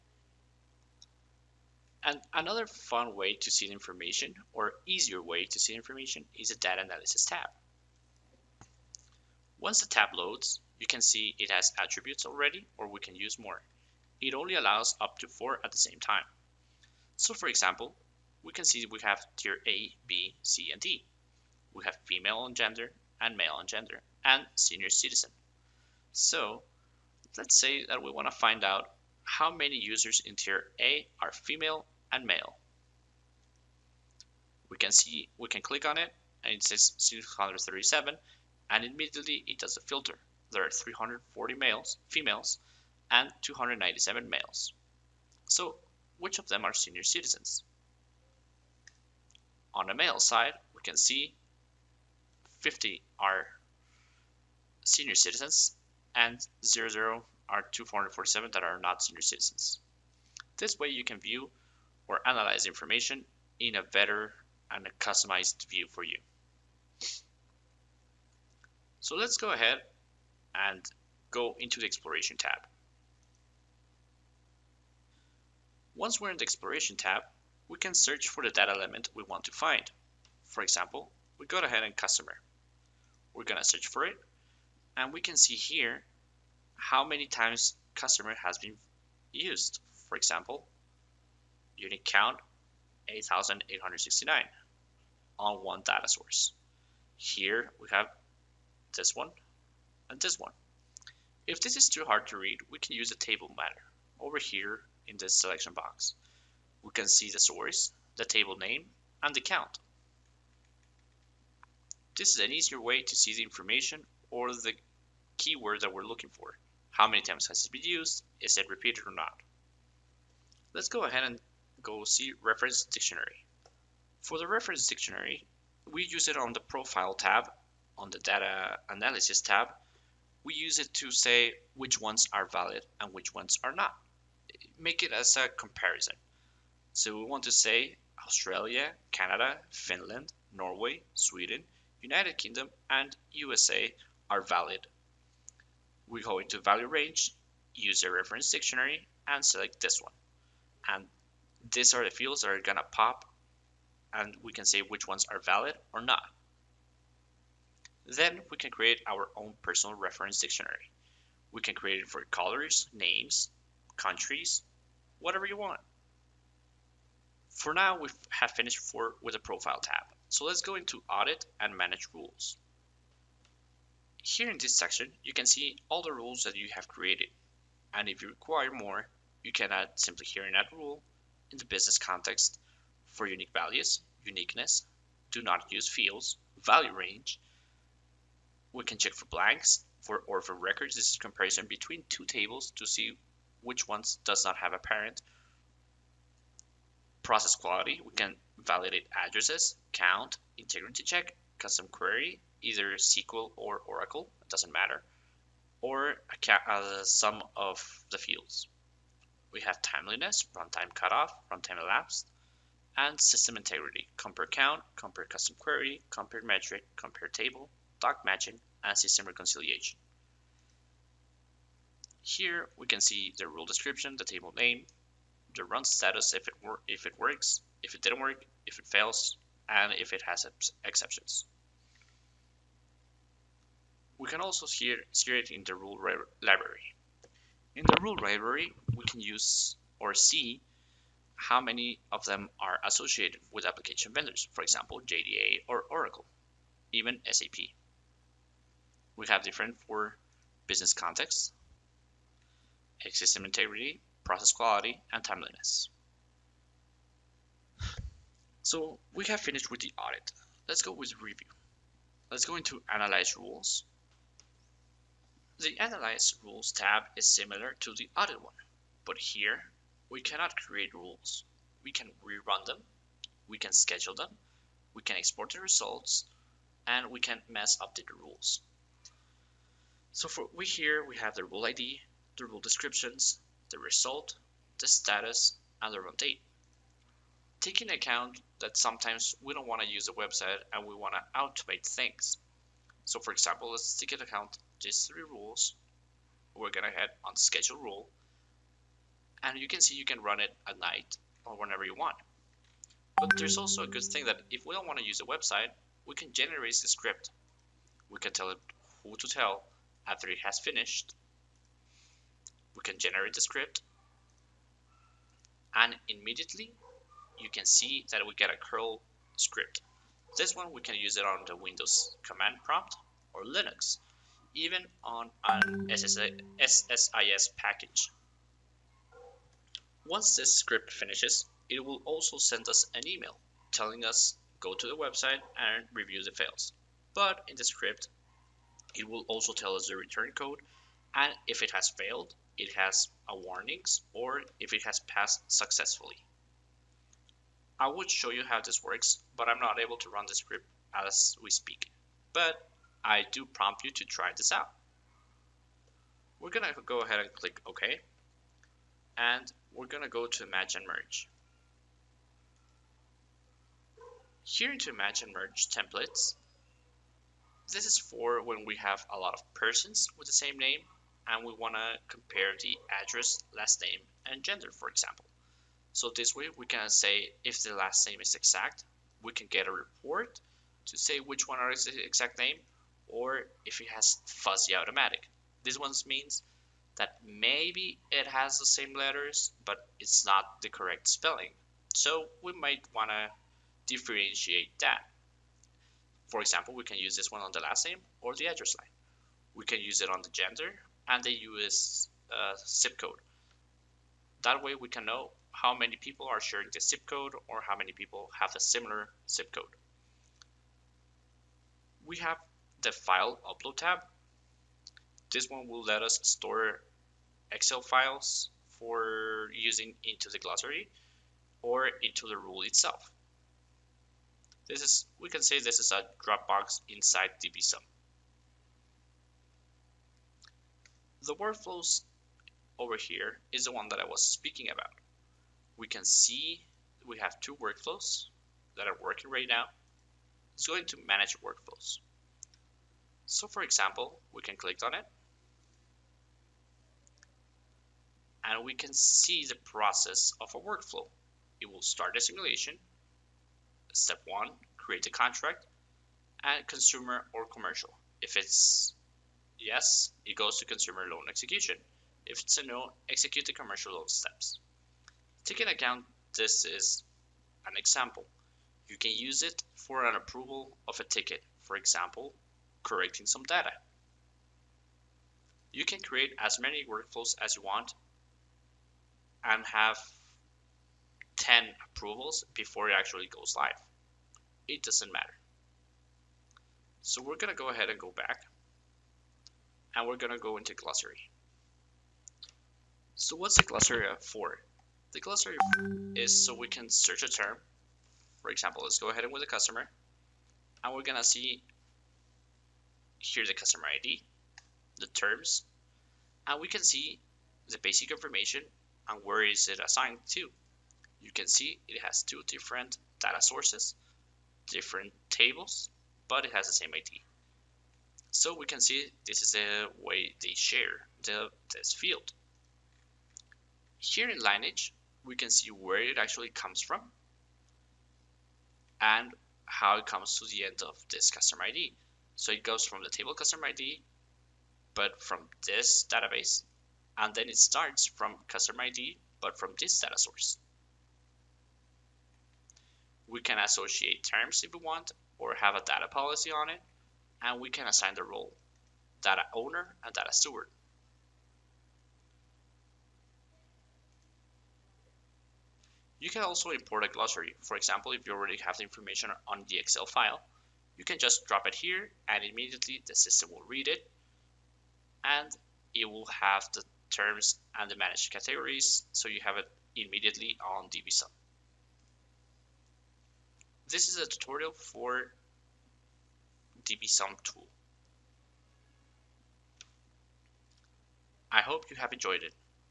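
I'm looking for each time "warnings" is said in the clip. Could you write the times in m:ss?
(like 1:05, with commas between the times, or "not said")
5:43.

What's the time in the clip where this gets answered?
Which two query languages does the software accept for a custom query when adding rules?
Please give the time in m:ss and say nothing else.
3:22.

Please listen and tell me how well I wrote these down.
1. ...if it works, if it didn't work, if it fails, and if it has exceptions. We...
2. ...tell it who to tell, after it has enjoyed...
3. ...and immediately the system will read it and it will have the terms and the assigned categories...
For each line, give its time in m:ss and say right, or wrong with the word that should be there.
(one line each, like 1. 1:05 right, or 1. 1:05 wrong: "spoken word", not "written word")
1. 3:46 right
2. 5:08 wrong: "finished", not "enjoyed"
3. 9:22 wrong: "managed", not "assigned".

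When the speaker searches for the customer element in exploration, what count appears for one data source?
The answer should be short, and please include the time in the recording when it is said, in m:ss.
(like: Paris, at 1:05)
8,869, at 1:33.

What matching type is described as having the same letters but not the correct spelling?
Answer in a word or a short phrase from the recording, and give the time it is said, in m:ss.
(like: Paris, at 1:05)
fuzzy automatic, at 6:24.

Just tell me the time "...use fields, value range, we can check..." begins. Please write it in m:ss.
3:05.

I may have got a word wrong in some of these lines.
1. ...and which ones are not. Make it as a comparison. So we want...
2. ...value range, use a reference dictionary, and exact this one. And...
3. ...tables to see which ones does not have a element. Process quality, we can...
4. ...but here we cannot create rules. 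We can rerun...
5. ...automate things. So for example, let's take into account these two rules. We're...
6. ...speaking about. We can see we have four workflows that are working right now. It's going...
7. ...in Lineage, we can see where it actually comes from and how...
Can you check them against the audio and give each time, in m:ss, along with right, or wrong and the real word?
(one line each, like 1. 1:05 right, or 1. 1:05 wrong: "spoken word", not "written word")
1. 2:12 right
2. 2:26 wrong: "select", not "exact"
3. 3:12 wrong: "parent", not "element"
4. 4:29 right
5. 4:51 wrong: "three", not "two"
6. 7:14 wrong: "two", not "four"
7. 8:44 right.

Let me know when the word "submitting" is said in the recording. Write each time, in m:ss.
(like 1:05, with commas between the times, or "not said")
not said.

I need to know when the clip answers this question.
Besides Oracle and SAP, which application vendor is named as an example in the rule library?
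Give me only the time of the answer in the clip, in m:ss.
4:05.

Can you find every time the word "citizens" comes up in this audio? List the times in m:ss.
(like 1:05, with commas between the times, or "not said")
0:24, 0:47, 0:55, 0:59.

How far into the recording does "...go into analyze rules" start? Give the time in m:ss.
4:22.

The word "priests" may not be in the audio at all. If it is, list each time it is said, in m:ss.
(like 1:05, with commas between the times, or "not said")
not said.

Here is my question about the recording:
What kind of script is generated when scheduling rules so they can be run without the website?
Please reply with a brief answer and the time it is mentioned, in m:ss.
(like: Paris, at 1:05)
curl script, at 5:18.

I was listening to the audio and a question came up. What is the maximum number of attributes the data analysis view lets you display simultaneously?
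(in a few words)
4.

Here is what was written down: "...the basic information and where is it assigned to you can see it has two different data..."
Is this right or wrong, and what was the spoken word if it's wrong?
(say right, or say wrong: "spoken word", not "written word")
right.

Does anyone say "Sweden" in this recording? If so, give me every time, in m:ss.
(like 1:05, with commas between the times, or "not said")
2:21.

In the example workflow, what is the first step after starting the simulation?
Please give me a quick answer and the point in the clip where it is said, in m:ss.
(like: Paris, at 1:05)
create a contract, at 7:34.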